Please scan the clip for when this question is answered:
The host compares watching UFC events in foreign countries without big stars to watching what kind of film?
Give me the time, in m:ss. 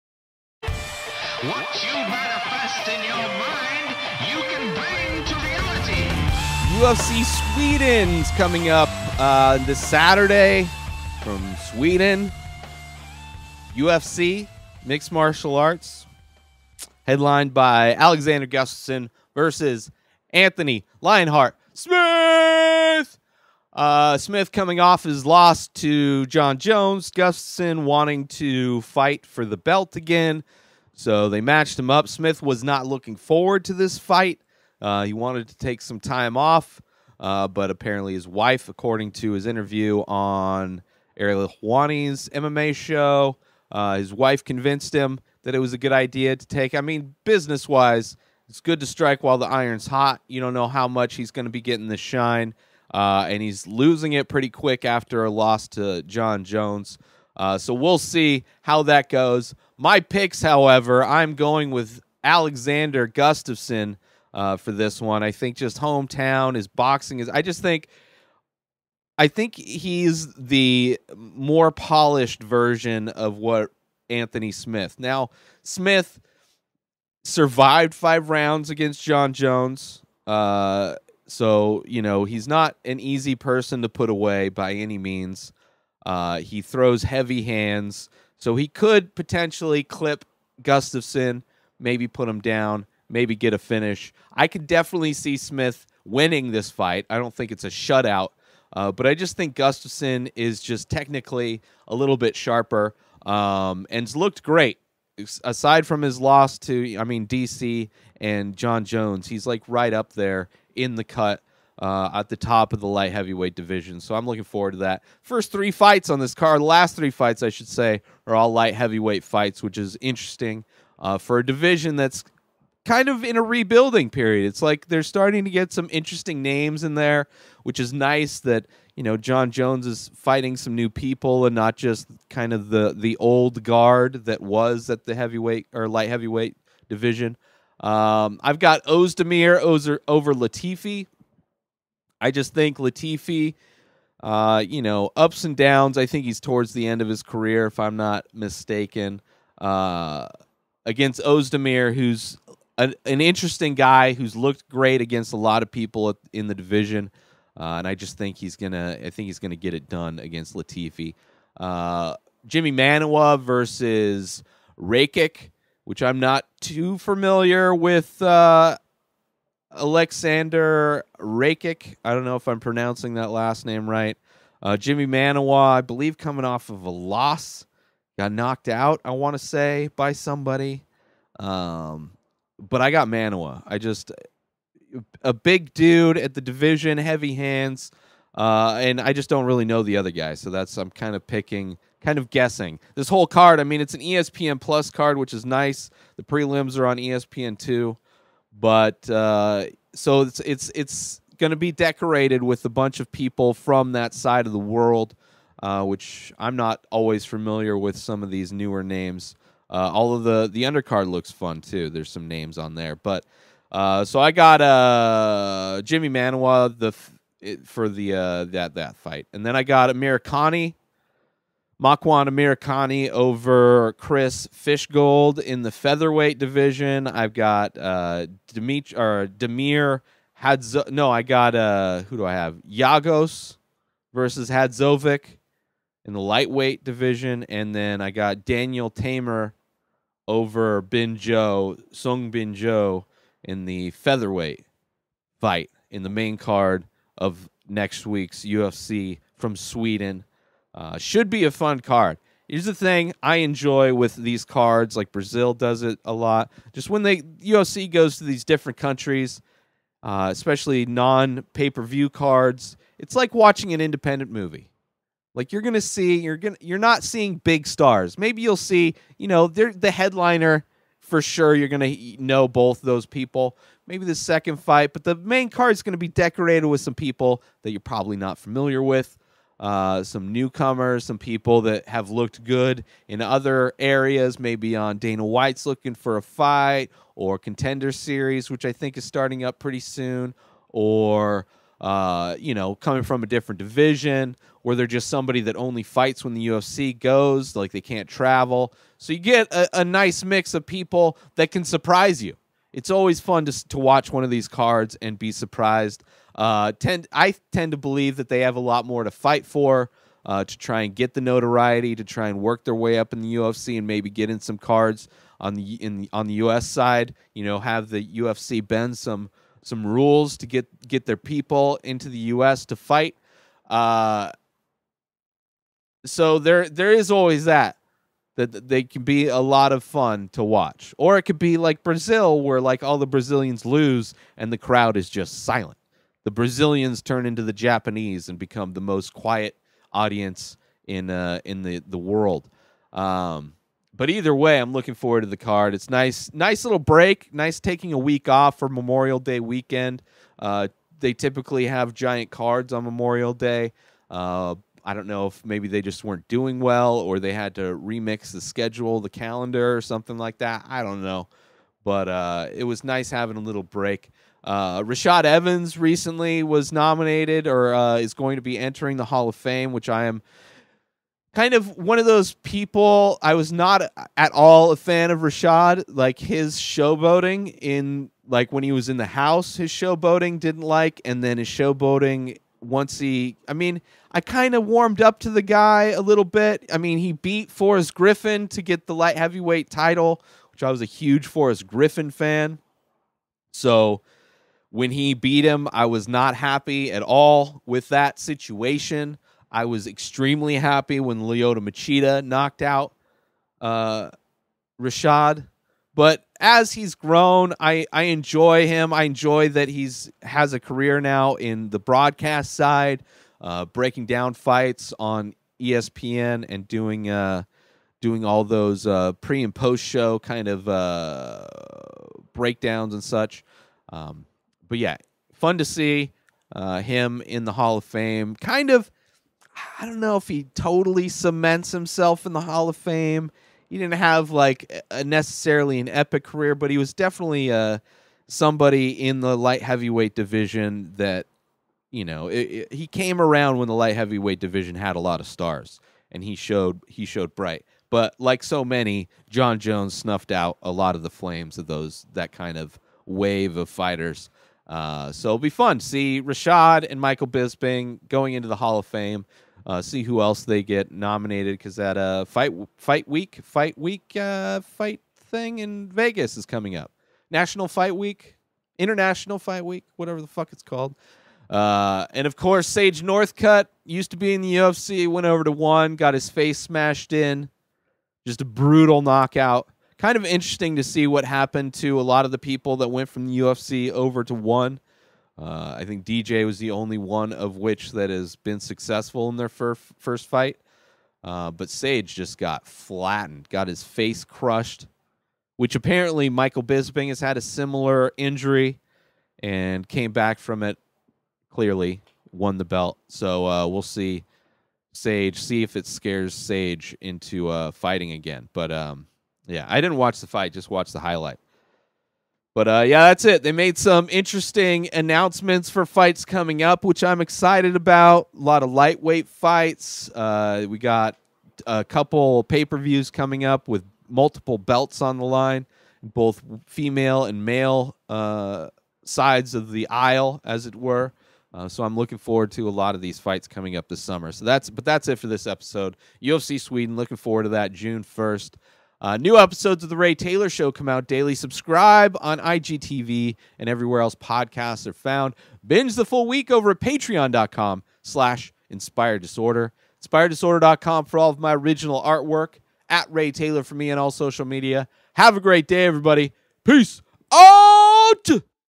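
4:23.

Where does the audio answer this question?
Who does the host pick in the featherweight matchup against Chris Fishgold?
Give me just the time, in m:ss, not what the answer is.
3:41.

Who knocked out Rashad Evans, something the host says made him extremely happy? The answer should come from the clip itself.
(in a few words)
Lyoto Machida.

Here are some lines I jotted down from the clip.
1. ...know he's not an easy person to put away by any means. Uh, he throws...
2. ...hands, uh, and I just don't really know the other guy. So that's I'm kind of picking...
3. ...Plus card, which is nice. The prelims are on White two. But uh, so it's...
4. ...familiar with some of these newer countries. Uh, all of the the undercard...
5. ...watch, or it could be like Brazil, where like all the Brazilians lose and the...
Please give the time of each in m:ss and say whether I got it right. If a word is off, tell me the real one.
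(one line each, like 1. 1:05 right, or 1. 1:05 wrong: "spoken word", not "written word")
1. 1:22 right
2. 3:07 right
3. 3:14 wrong: "ESPN", not "White"
4. 3:27 wrong: "names", not "countries"
5. 5:30 right.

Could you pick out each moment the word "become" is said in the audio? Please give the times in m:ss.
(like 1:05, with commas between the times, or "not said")
5:38.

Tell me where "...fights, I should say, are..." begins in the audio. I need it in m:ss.
1:57.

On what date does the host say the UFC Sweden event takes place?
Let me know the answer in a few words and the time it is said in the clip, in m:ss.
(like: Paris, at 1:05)
June 1st, at 8:57.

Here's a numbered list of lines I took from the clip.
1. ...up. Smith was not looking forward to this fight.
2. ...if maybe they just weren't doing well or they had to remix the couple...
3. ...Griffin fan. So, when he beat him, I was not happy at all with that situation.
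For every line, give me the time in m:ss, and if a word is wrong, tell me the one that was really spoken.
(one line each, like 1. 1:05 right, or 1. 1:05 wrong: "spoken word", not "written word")
1. 0:31 right
2. 5:55 wrong: "schedule", not "couple"
3. 6:31 right.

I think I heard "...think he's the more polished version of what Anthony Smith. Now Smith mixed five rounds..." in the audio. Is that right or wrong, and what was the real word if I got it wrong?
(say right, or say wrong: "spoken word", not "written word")
wrong: "survived", not "mixed".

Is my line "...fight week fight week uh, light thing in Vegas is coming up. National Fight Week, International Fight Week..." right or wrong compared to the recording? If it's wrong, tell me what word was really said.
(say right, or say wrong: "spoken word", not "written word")
wrong: "fight", not "light".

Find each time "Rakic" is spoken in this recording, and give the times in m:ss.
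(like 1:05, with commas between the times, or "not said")
2:44, 2:51.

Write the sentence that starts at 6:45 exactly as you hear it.
But as he's grown, I, I enjoy him.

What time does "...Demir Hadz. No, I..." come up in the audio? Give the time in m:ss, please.
3:49.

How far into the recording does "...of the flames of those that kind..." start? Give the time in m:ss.
7:30.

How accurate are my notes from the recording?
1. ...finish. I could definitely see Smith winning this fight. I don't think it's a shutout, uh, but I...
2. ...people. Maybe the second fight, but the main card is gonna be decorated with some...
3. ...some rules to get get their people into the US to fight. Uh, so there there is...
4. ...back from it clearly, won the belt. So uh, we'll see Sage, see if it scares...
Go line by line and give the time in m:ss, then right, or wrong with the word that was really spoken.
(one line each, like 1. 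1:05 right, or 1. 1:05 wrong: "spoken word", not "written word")
1. 1:33 right
2. 4:33 right
3. 5:19 right
4. 8:20 right.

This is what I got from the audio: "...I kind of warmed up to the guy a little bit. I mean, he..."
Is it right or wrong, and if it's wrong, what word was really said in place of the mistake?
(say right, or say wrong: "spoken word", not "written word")
right.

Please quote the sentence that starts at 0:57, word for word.
Uh, so we'll see how that goes.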